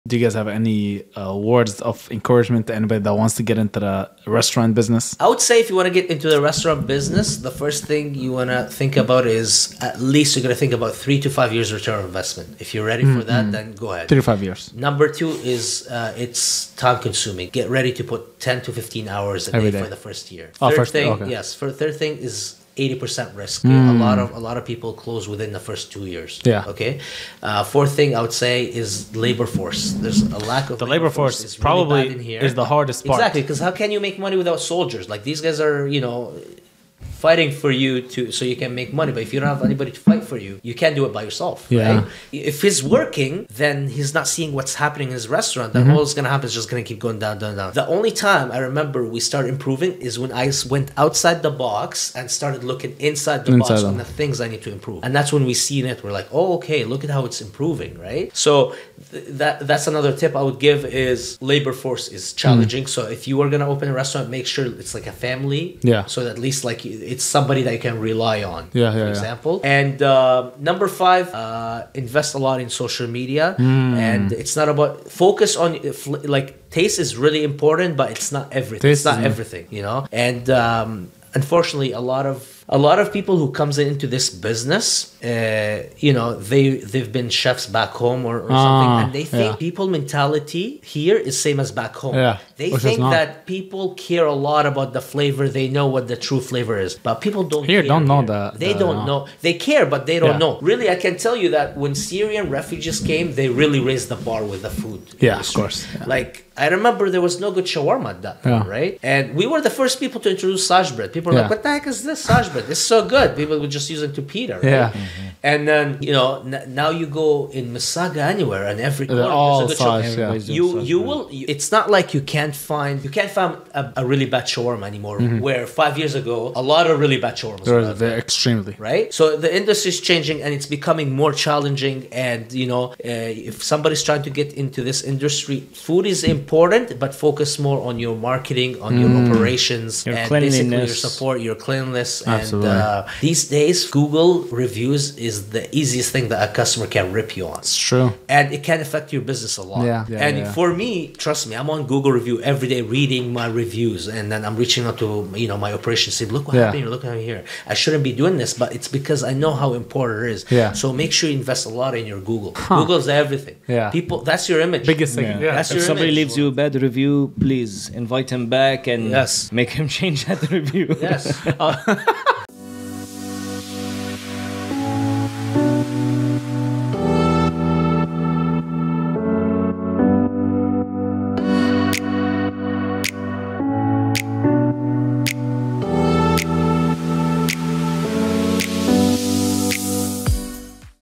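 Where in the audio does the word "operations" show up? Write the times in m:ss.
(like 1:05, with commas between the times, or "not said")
2:19, 2:35.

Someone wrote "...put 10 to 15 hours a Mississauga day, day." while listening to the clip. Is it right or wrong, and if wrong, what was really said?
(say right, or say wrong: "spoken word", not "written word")
wrong: "Every", not "Mississauga".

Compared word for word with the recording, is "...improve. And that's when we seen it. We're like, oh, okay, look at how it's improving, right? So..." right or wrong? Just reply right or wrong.
right.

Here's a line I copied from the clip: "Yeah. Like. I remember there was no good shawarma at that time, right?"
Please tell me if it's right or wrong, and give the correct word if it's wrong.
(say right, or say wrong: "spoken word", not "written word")
right.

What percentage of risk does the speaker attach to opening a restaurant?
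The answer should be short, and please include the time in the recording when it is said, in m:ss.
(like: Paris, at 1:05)
80 percent, at 0:22.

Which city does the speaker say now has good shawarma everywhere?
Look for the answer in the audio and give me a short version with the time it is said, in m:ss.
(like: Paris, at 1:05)
Mississauga, at 1:57.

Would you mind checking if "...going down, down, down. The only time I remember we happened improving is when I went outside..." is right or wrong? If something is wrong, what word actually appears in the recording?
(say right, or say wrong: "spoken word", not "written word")
wrong: "started", not "happened".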